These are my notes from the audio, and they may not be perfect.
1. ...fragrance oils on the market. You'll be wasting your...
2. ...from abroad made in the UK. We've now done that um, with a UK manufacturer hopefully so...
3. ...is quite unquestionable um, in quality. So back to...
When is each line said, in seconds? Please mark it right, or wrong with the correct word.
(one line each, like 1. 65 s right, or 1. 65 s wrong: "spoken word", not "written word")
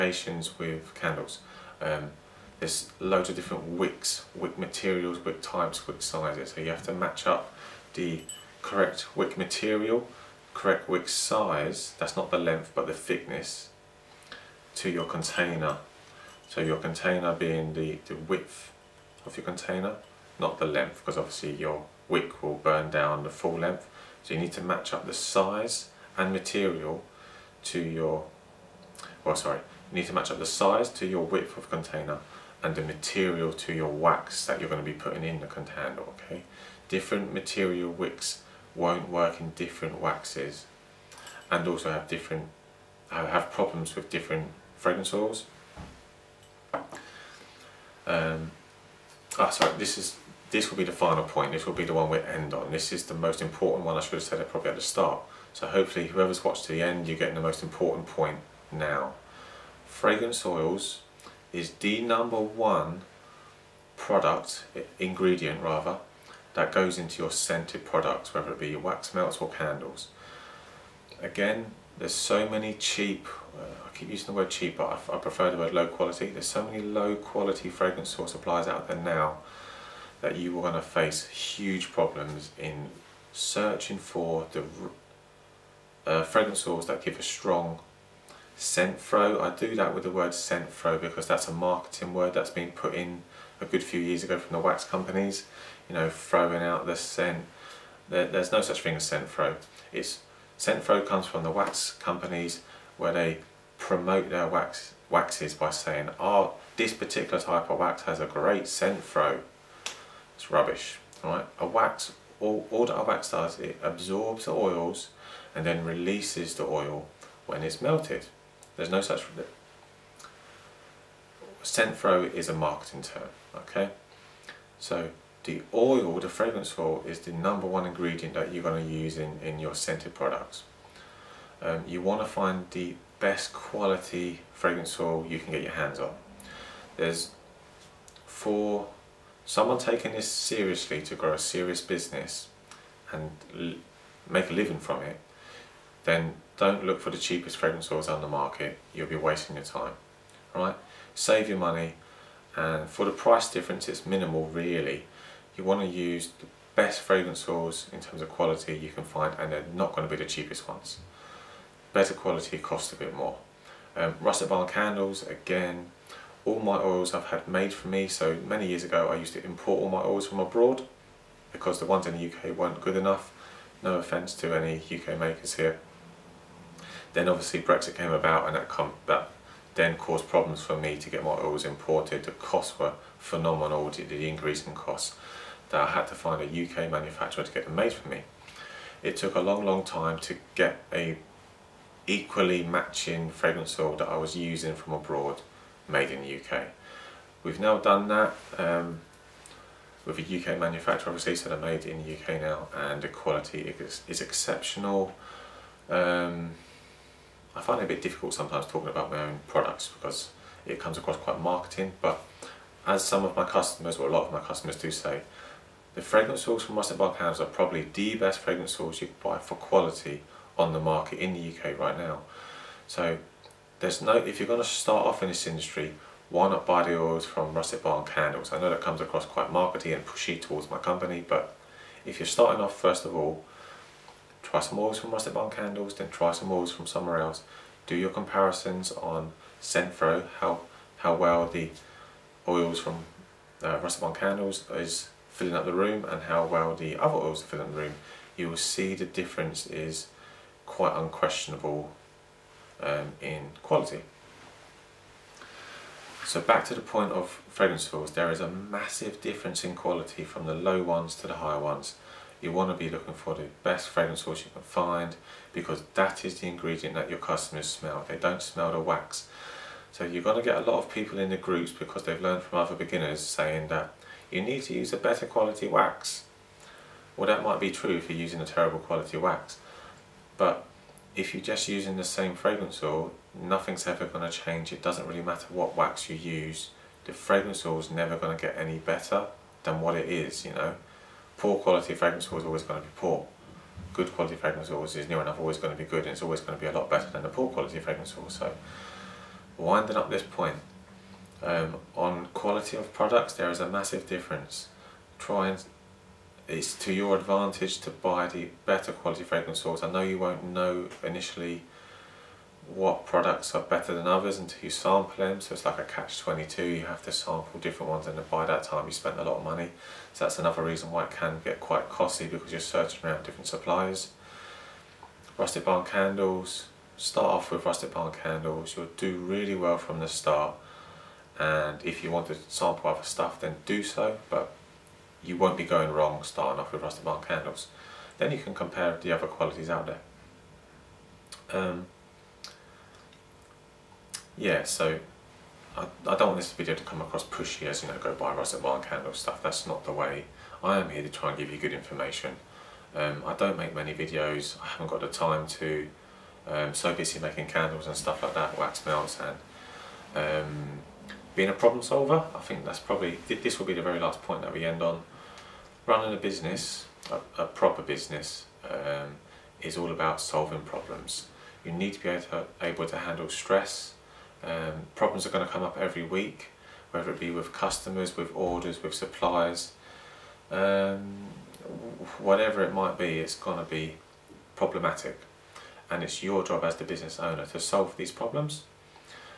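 1. 147 s right
2. 194 s wrong: "obviously", not "hopefully"
3. 249 s right.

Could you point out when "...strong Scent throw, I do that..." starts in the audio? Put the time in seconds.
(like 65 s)
87 s.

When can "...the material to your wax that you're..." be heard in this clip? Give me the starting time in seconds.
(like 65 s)
32 s.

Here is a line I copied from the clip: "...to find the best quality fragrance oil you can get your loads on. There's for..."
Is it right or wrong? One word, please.
wrong.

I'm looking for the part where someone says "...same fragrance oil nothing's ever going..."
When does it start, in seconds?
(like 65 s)
282 s.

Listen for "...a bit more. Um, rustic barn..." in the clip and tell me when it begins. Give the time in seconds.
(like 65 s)
162 s.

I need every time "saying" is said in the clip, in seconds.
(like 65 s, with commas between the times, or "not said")
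105 s, 273 s.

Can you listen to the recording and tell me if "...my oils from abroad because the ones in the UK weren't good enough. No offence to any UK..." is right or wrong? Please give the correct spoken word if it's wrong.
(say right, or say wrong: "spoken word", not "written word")
right.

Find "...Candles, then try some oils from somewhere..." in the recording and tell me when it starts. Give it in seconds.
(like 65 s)
235 s.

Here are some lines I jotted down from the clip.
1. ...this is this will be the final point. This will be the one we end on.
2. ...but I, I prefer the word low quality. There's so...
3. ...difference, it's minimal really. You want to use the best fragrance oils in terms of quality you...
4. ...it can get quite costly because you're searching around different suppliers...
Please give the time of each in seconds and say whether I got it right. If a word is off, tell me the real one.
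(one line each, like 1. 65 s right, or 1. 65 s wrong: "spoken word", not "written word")
1. 49 s right
2. 74 s right
3. 153 s right
4. 321 s right.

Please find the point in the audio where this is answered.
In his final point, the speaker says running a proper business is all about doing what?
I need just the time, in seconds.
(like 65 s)
370 s.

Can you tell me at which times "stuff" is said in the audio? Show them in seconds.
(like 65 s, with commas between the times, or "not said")
333 s, 349 s, 357 s.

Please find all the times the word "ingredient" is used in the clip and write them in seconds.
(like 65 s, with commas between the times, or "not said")
64 s, 127 s, 266 s.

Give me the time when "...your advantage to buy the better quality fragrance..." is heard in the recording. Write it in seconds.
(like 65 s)
306 s.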